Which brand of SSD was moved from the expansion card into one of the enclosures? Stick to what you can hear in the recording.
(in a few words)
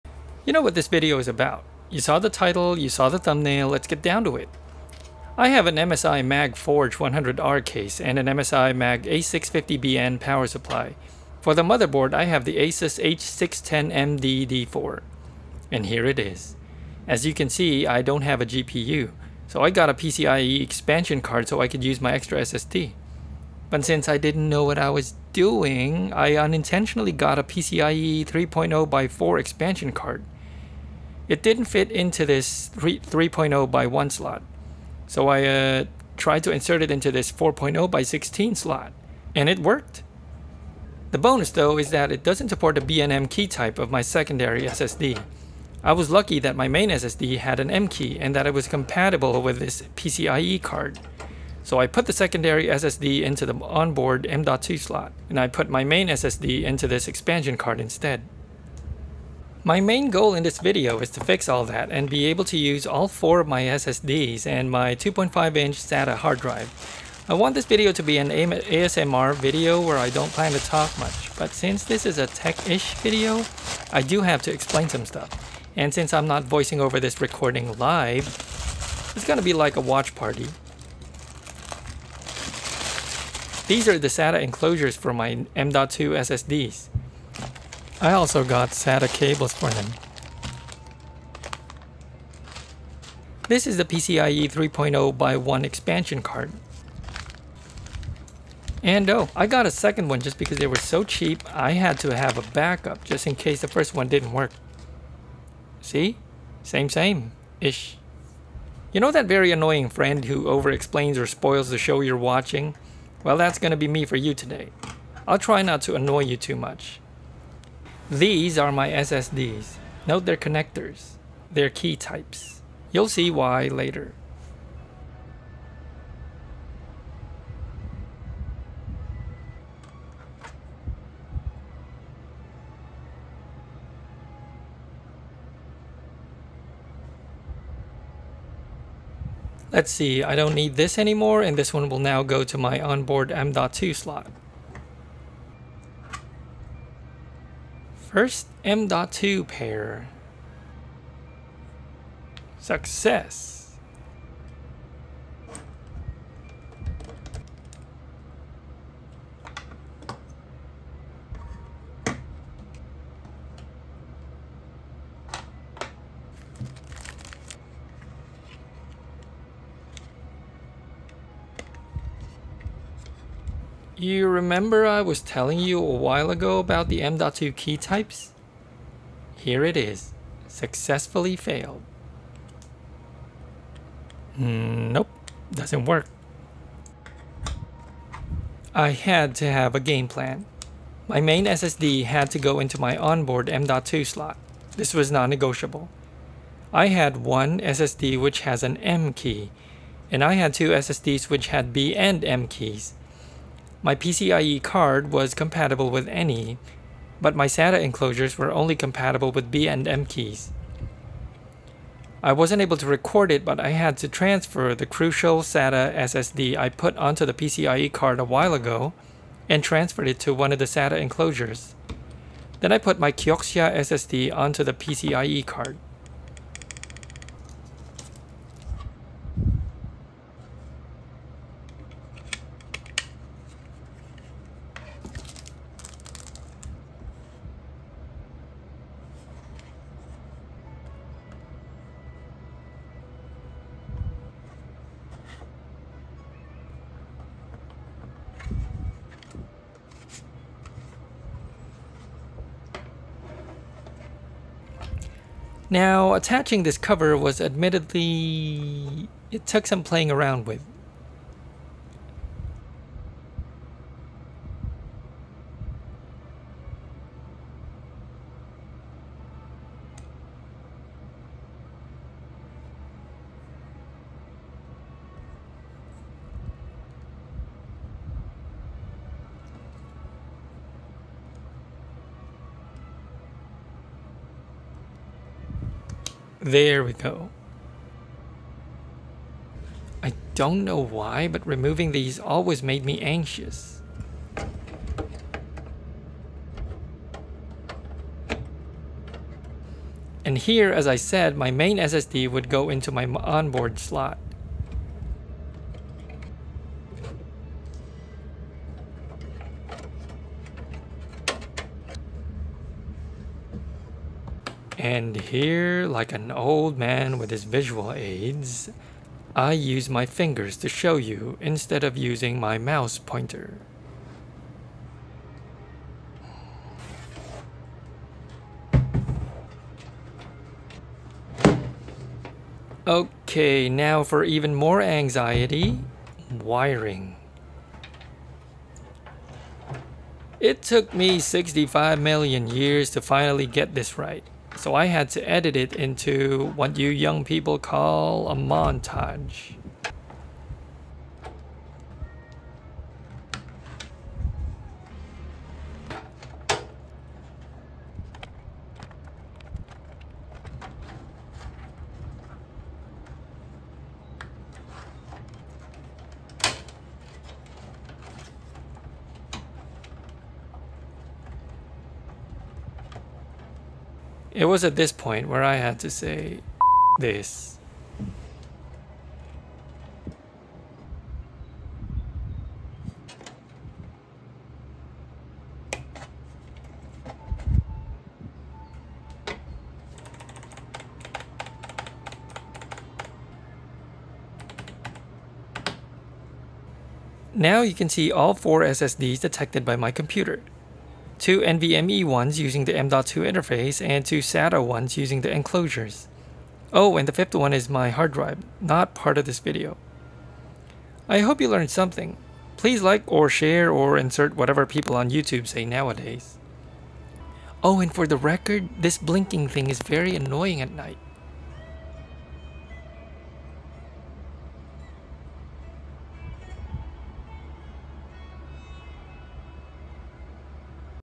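Crucial.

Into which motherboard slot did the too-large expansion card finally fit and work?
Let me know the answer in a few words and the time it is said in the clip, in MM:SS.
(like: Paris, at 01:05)
4.0 x16 slot, at 00:37.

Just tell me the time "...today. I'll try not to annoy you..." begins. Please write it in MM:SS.
01:54.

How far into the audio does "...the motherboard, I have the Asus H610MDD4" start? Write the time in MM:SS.
00:11.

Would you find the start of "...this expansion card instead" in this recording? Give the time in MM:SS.
00:56.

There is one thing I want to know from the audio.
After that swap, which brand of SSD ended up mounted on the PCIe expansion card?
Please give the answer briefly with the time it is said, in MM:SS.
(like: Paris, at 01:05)
Kioxia, at 03:43.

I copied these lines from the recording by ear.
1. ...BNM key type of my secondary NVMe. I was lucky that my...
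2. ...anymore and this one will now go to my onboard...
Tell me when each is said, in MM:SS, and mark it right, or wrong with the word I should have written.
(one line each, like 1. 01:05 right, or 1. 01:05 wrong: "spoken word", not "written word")
1. 00:42 wrong: "SSD", not "NVMe"
2. 02:20 right.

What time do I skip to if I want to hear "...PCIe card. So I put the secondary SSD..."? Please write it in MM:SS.
00:49.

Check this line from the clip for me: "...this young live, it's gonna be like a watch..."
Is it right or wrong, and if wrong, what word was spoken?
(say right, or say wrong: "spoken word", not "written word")
wrong: "recording", not "young".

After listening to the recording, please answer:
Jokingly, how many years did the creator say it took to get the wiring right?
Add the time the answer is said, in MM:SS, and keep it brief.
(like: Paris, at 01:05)
65 million, at 05:41.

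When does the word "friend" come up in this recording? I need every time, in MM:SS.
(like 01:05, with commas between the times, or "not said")
01:49.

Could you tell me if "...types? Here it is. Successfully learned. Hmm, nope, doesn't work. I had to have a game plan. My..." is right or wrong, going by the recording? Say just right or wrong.
wrong.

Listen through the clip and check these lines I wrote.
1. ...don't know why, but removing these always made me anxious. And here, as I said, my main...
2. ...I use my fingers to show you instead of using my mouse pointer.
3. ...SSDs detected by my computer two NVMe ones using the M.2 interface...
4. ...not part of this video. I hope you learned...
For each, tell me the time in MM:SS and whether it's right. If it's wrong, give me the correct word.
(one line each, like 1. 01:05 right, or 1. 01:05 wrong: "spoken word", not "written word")
1. 04:50 right
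2. 05:19 right
3. 06:38 right
4. 06:48 right.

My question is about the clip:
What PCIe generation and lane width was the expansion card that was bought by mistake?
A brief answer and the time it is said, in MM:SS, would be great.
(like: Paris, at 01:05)
PCIe 3.0 x4, at 00:27.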